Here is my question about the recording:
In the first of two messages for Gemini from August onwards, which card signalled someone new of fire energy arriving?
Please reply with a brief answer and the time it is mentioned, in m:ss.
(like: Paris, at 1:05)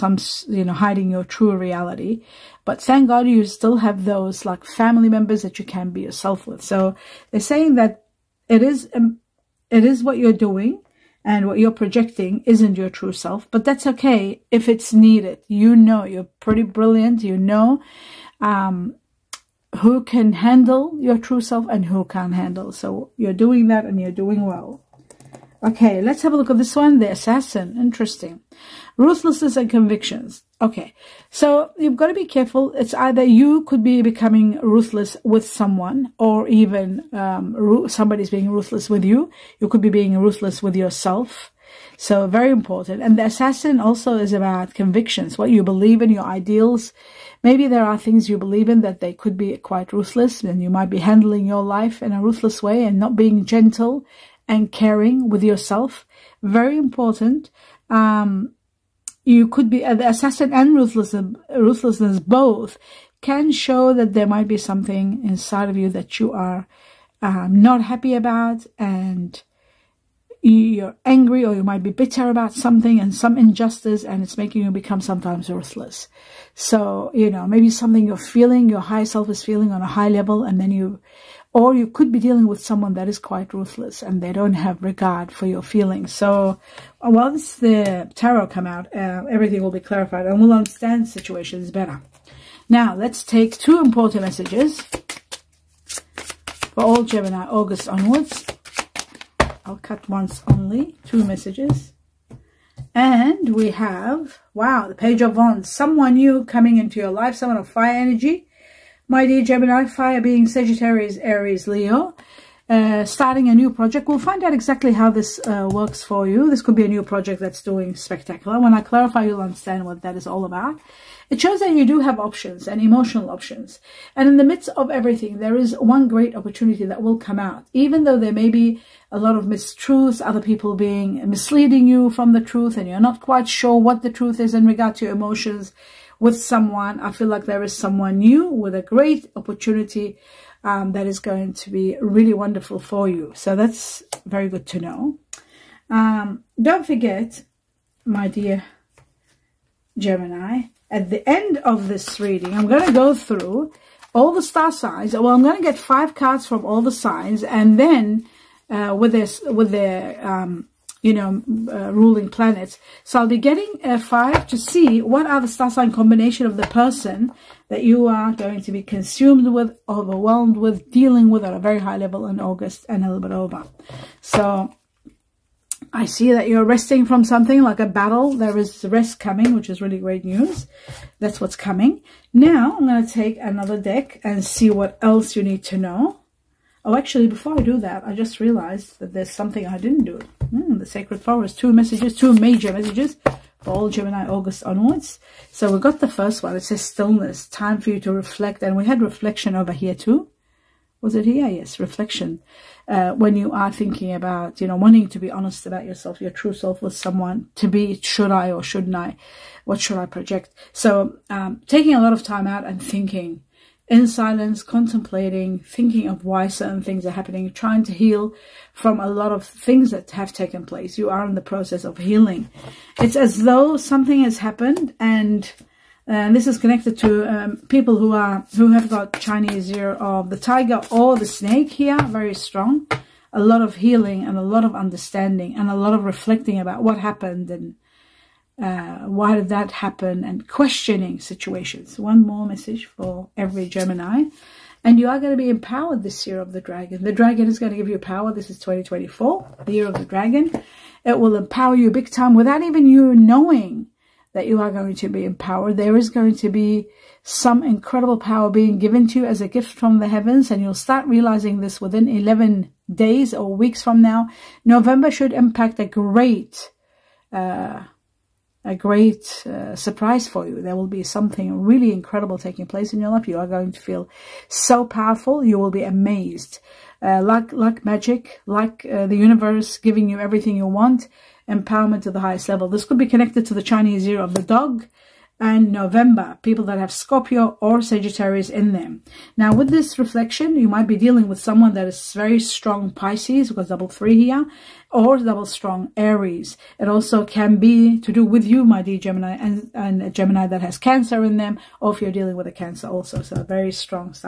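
Page of Wands, at 1:44.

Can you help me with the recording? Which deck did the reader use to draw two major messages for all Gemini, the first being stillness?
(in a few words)
The Sacred Forest.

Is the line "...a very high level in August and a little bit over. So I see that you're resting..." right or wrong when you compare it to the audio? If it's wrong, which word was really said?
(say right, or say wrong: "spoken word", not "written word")
right.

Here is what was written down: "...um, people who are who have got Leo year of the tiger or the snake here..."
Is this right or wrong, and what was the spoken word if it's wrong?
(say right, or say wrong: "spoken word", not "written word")
wrong: "Chinese", not "Leo".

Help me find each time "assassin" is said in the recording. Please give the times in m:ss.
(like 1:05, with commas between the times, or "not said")
0:27, 0:43, 1:00.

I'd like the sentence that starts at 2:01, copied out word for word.
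It shows that you do have options and emotional options.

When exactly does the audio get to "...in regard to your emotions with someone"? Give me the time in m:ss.
2:14.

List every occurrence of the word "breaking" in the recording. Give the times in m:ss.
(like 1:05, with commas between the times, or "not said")
not said.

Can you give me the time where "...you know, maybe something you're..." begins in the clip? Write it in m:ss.
1:17.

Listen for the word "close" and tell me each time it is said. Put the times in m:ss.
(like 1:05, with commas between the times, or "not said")
not said.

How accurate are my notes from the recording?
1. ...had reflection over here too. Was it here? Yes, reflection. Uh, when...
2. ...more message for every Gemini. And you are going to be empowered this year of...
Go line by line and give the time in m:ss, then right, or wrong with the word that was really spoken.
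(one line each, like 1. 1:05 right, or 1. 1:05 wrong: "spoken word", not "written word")
1. 3:18 right
2. 4:02 right.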